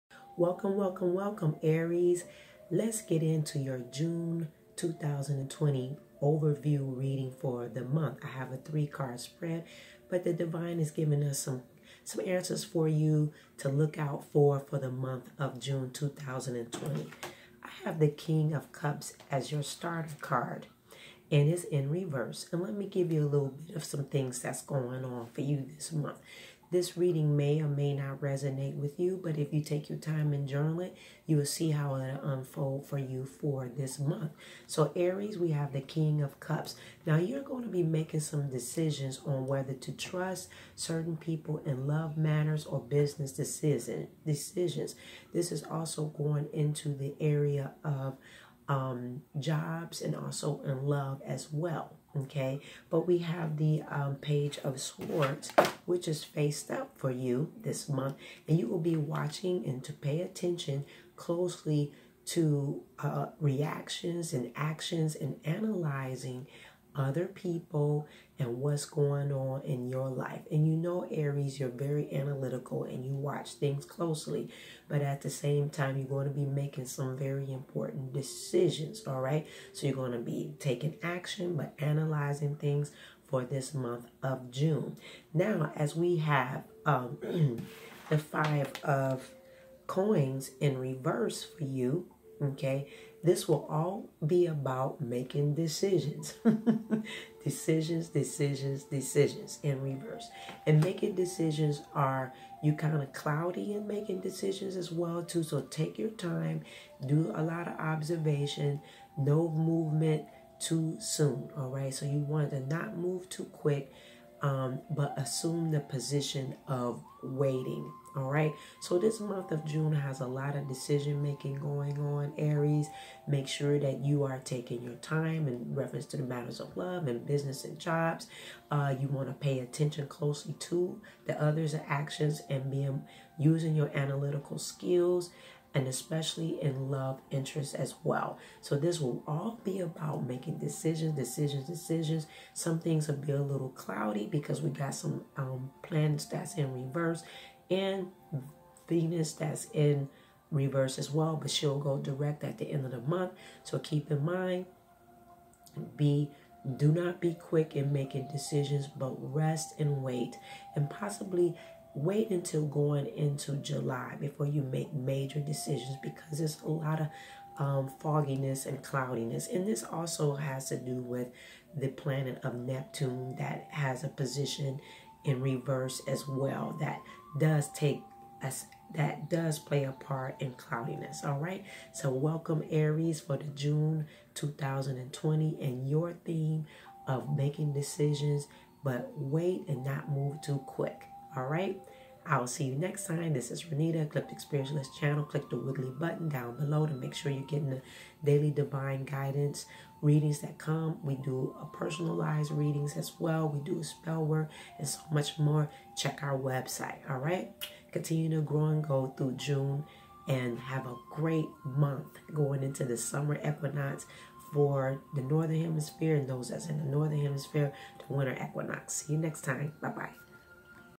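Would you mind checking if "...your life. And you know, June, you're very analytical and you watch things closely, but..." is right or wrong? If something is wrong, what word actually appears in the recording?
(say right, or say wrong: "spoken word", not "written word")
wrong: "Aries", not "June".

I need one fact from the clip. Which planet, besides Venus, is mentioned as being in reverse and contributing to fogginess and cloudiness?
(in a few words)
Neptune.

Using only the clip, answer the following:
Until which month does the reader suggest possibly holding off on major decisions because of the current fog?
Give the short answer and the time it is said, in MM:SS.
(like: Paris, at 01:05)
July, at 02:43.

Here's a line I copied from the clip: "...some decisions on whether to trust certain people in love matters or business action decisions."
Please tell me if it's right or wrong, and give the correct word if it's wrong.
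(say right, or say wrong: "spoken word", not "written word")
wrong: "decision", not "action".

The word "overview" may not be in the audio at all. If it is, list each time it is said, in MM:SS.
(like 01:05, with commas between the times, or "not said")
00:06.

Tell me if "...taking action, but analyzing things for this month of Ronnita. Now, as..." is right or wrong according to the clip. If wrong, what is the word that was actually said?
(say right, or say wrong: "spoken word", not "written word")
wrong: "June", not "Ronnita".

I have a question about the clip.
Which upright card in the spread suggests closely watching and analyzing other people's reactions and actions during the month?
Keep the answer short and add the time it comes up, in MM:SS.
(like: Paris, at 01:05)
Page of Swords, at 00:54.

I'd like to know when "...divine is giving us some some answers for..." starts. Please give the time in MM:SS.
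00:10.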